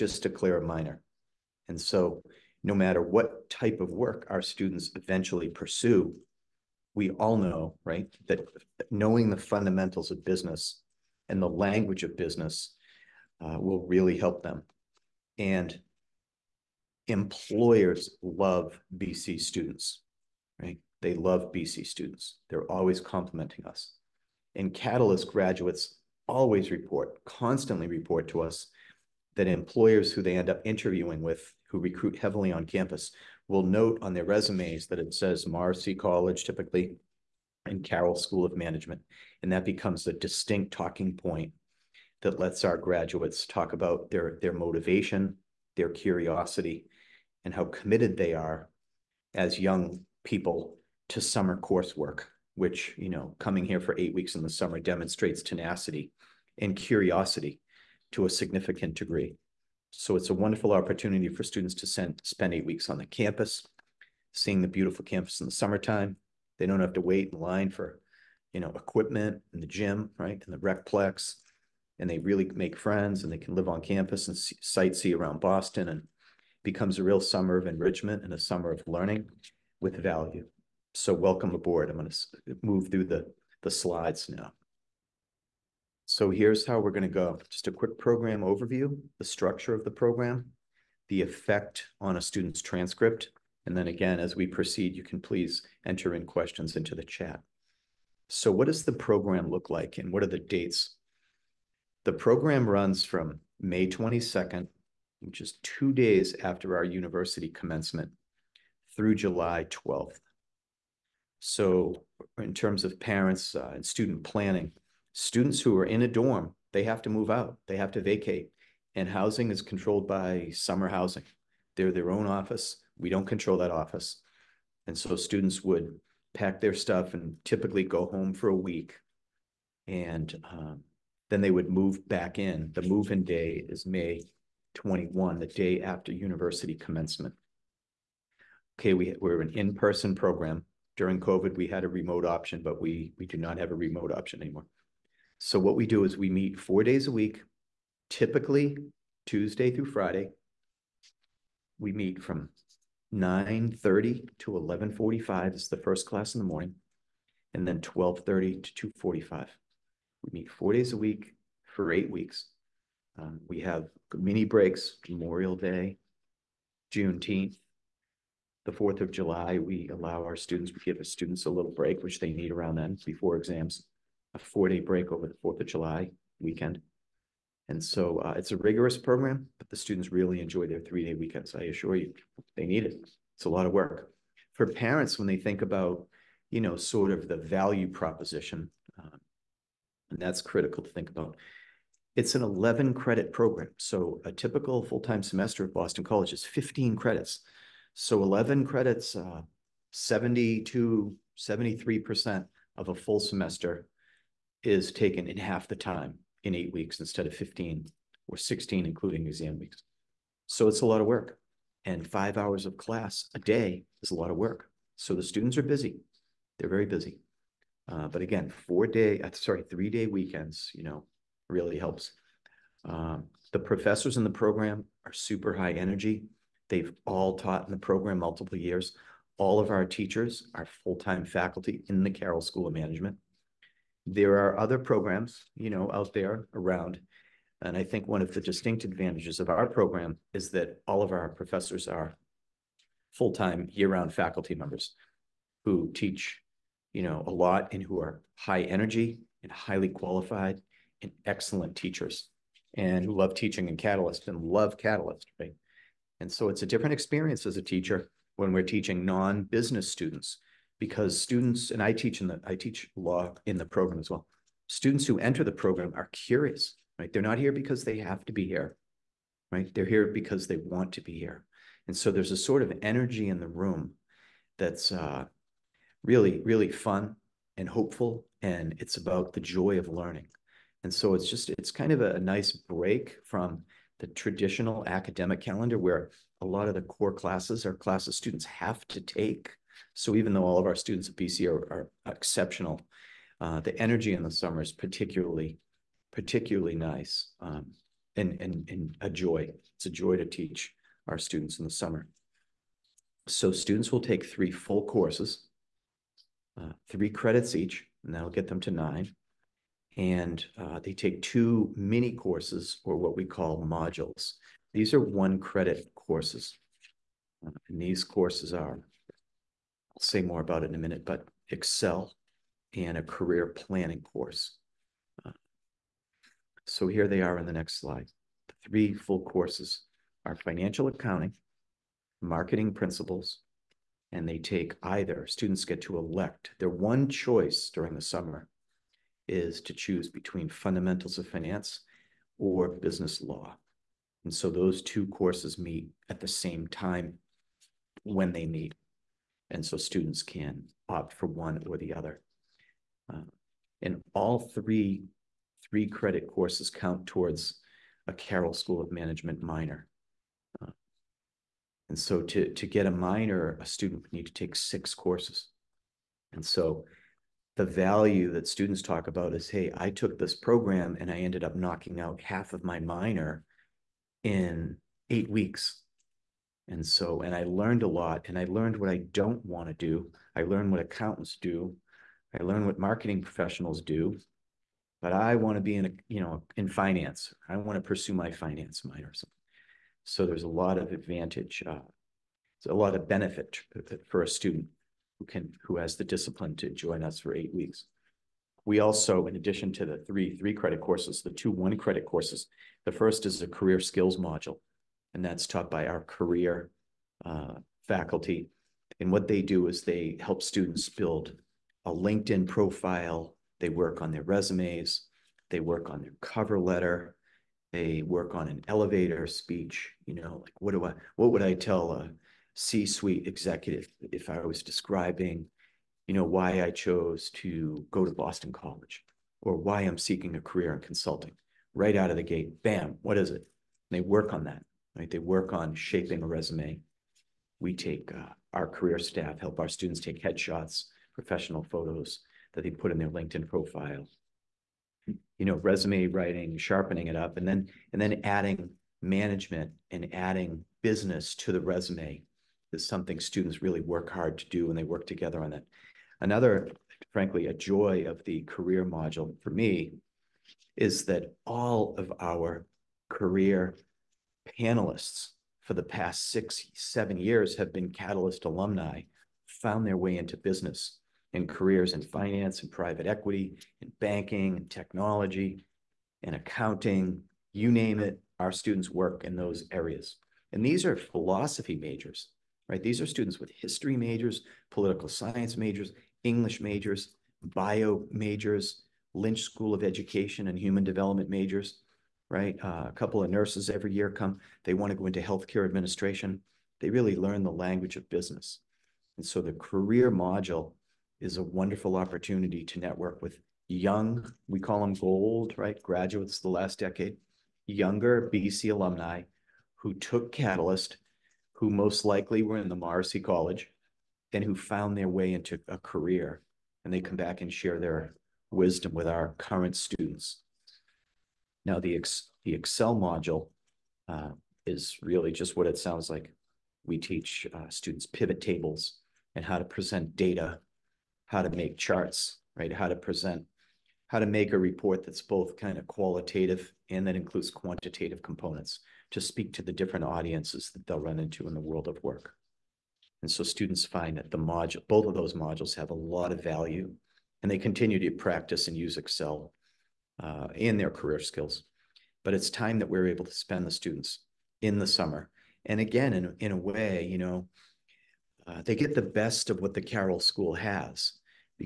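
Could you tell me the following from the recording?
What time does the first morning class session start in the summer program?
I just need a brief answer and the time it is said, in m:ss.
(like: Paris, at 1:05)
9:30, at 2:33.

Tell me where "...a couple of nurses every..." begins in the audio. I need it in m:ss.
8:12.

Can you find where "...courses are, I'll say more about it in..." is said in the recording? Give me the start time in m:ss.
5:18.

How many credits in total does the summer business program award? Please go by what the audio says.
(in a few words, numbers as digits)
11.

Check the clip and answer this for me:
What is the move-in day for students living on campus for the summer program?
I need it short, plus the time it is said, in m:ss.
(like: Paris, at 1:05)
May 21, at 2:13.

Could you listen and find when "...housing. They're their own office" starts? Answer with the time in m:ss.
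2:00.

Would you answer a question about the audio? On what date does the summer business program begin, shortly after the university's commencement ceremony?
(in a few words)
May 22.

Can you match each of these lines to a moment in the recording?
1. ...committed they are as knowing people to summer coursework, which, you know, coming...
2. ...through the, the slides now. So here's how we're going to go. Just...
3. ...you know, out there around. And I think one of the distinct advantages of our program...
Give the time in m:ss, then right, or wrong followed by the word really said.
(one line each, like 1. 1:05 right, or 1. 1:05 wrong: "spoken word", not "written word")
1. 0:47 wrong: "young", not "knowing"
2. 1:22 right
3. 3:55 right.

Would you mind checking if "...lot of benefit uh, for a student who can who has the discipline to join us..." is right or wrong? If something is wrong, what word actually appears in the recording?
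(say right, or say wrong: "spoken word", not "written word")
right.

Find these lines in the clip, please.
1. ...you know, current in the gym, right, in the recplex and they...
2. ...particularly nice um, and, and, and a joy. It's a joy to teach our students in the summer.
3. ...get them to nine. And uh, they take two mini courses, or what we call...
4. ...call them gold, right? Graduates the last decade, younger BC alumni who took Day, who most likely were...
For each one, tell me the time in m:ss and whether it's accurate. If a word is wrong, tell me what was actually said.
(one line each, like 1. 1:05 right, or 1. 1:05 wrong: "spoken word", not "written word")
1. 1:08 wrong: "equipment", not "current"
2. 4:56 right
3. 5:08 right
4. 8:24 wrong: "Catalyst", not "Day".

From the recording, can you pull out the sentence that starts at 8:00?
And these are philosophy majors, right?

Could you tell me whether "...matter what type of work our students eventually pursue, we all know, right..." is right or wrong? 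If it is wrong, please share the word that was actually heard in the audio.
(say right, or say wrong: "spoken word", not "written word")
right.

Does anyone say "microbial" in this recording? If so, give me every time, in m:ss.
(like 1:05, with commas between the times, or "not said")
not said.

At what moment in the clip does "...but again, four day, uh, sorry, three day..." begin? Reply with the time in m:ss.
3:38.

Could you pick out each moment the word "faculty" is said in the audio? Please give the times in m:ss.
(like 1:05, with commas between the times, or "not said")
3:51, 4:04, 6:47.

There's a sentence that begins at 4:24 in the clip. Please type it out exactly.
Students who enter the program are curious, right?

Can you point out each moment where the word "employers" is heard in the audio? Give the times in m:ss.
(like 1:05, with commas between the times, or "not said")
0:17, 0:29.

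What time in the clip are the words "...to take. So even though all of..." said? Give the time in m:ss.
4:48.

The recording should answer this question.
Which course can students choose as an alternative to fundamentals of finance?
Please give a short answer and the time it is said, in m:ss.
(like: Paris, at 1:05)
Business law, at 5:42.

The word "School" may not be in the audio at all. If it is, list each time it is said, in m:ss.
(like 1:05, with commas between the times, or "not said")
0:38, 3:52, 5:58, 8:09, 9:20.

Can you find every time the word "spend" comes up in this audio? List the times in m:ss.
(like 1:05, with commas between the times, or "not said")
1:02, 9:13.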